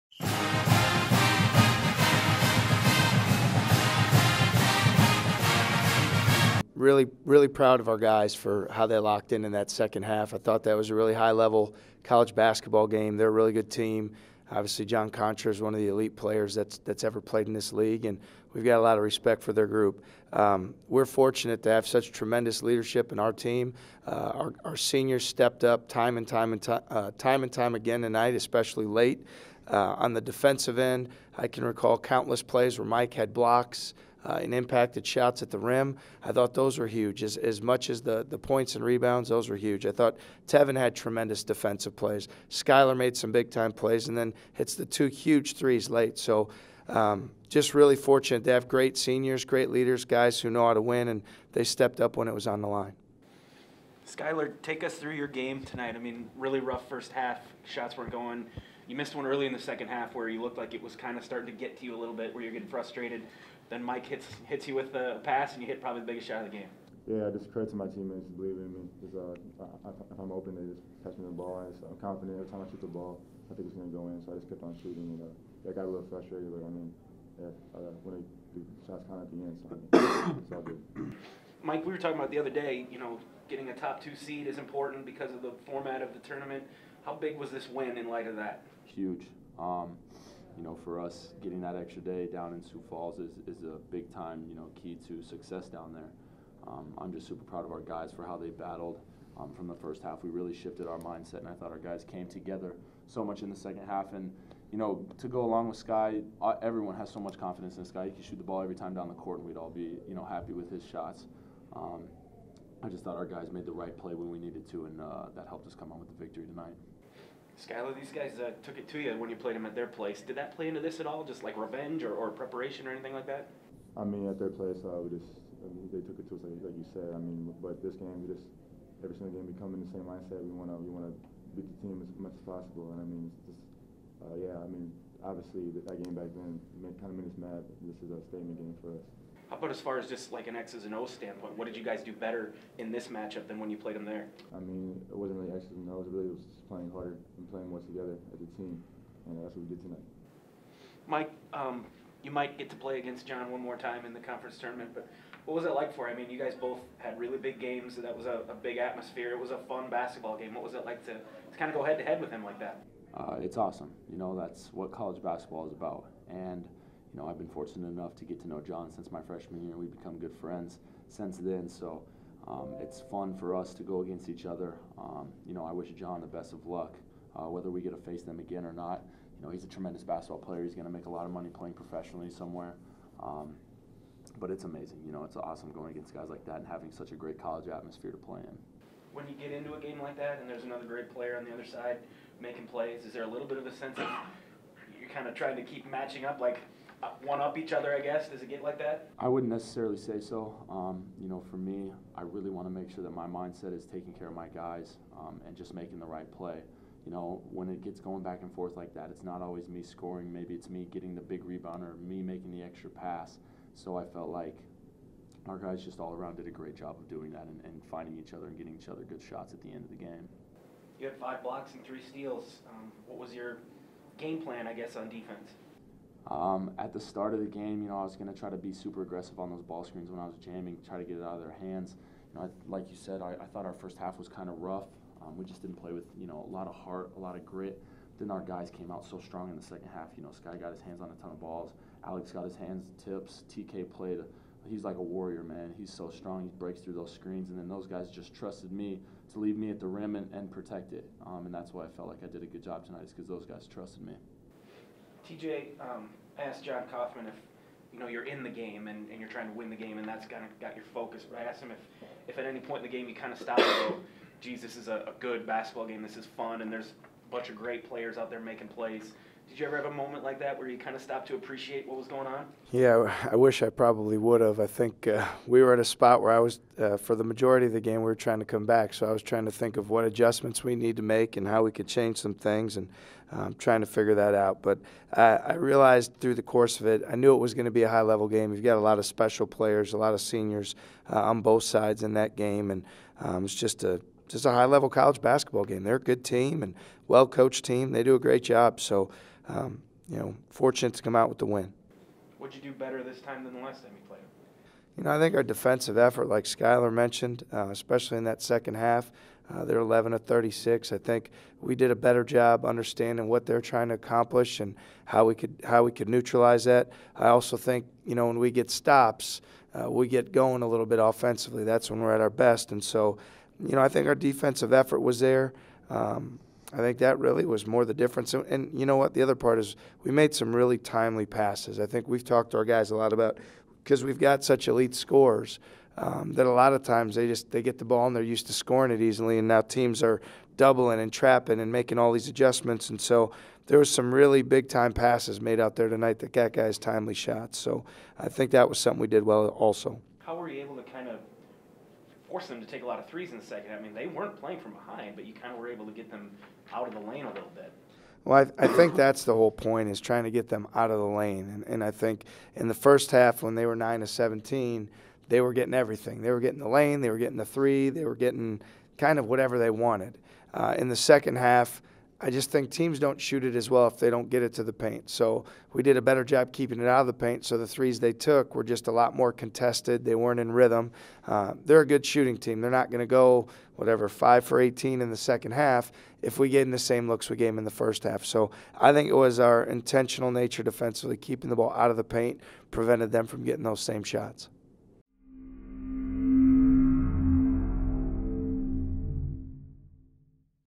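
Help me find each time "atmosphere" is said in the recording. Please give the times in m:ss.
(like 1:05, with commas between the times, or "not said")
2:38, 3:07.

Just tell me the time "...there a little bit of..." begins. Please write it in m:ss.
3:13.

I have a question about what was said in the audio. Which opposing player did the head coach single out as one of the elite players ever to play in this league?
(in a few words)
John Konchar.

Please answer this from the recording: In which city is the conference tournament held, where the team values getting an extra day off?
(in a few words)
Sioux Falls.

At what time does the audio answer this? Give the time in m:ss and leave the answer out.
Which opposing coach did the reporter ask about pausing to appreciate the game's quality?
4:16.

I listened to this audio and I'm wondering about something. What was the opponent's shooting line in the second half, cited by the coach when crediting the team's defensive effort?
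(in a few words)
11 of 36.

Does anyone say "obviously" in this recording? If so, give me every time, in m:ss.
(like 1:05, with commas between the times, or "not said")
0:14, 2:15.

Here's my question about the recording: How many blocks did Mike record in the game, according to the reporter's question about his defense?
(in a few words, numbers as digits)
5.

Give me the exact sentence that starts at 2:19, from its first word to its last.
How about as far as just like an X's and O's standpoint?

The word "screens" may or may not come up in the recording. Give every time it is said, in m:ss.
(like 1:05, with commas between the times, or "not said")
3:49, 4:07.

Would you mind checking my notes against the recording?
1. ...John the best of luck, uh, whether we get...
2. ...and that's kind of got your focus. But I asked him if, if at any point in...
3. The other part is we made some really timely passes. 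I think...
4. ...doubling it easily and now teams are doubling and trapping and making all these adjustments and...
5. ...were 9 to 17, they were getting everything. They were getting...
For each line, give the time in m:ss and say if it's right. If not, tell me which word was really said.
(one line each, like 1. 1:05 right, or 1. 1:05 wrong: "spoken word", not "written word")
1. 2:55 right
2. 4:19 right
3. 5:29 right
4. 5:38 wrong: "scoring", not "doubling"
5. 6:03 right.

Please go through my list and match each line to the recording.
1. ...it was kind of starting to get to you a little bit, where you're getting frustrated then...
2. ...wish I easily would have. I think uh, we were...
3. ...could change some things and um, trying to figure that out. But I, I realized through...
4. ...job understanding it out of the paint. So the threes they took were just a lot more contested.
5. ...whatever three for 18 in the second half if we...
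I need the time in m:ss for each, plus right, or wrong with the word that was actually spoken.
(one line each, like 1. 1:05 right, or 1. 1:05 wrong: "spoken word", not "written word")
1. 1:00 right
2. 4:33 wrong: "probably", not "easily"
3. 4:41 right
4. 6:16 wrong: "keeping", not "understanding"
5. 6:23 wrong: "five", not "three".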